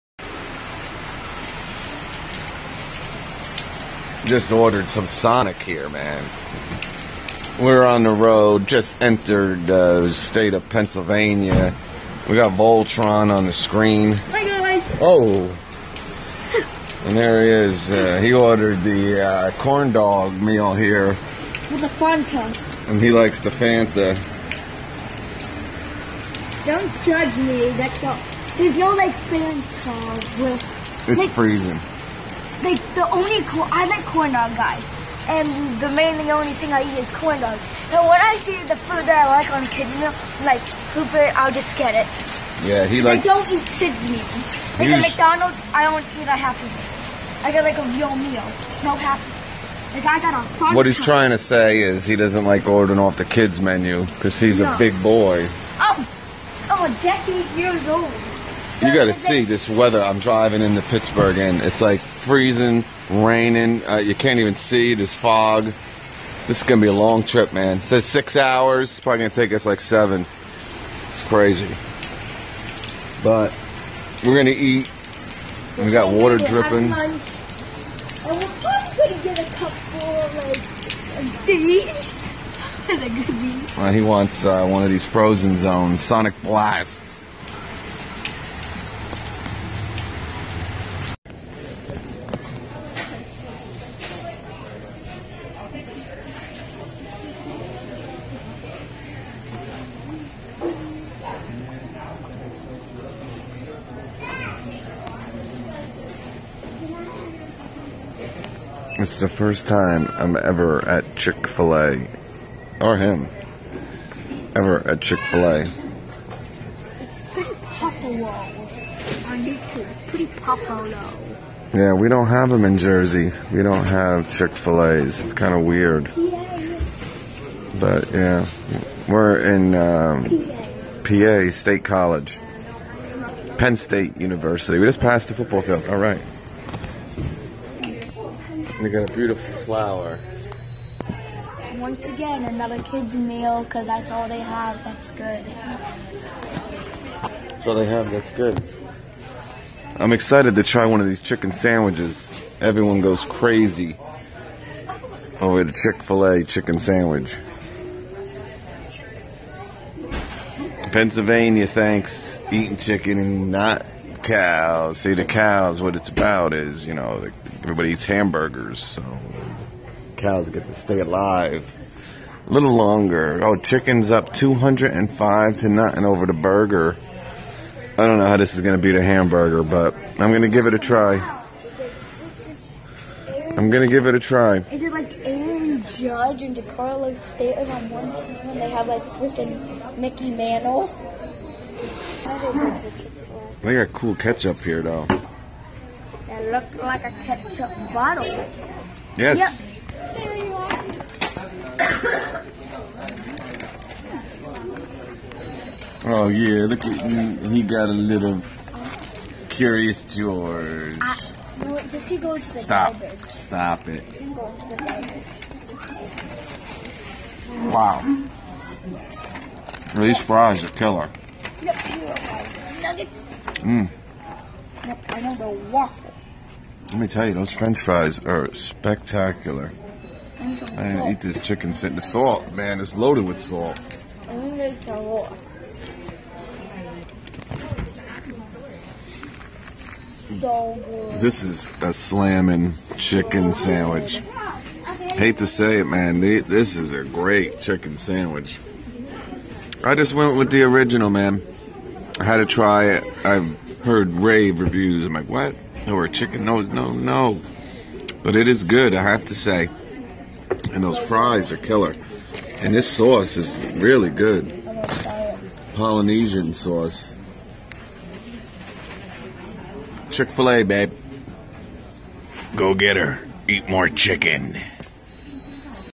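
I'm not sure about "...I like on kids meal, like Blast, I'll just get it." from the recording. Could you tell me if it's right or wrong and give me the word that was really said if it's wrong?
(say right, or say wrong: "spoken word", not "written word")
wrong: "Hooper", not "Blast".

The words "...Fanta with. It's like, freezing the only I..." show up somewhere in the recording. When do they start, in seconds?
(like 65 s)
29 s.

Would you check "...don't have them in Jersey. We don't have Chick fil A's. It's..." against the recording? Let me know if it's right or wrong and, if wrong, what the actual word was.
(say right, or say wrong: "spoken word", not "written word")
right.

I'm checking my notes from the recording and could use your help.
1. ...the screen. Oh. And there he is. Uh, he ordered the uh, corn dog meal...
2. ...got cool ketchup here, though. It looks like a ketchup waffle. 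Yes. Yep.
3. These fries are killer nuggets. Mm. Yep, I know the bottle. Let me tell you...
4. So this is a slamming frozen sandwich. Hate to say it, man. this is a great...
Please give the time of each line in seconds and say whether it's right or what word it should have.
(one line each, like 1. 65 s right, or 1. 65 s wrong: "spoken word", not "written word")
1. 13 s right
2. 193 s wrong: "bottle", not "waffle"
3. 219 s wrong: "waffle", not "bottle"
4. 240 s wrong: "chicken", not "frozen".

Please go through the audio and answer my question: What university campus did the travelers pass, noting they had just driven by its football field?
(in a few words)
Penn State University.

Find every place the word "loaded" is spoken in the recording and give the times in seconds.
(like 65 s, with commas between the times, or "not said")
232 s.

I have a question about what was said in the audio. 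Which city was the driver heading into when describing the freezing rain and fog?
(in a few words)
Pittsburgh.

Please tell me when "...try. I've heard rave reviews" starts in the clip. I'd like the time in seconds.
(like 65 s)
252 s.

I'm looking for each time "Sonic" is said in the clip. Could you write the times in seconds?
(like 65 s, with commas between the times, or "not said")
5 s, 86 s.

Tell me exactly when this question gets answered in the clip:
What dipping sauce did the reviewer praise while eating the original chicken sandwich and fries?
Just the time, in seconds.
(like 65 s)
265 s.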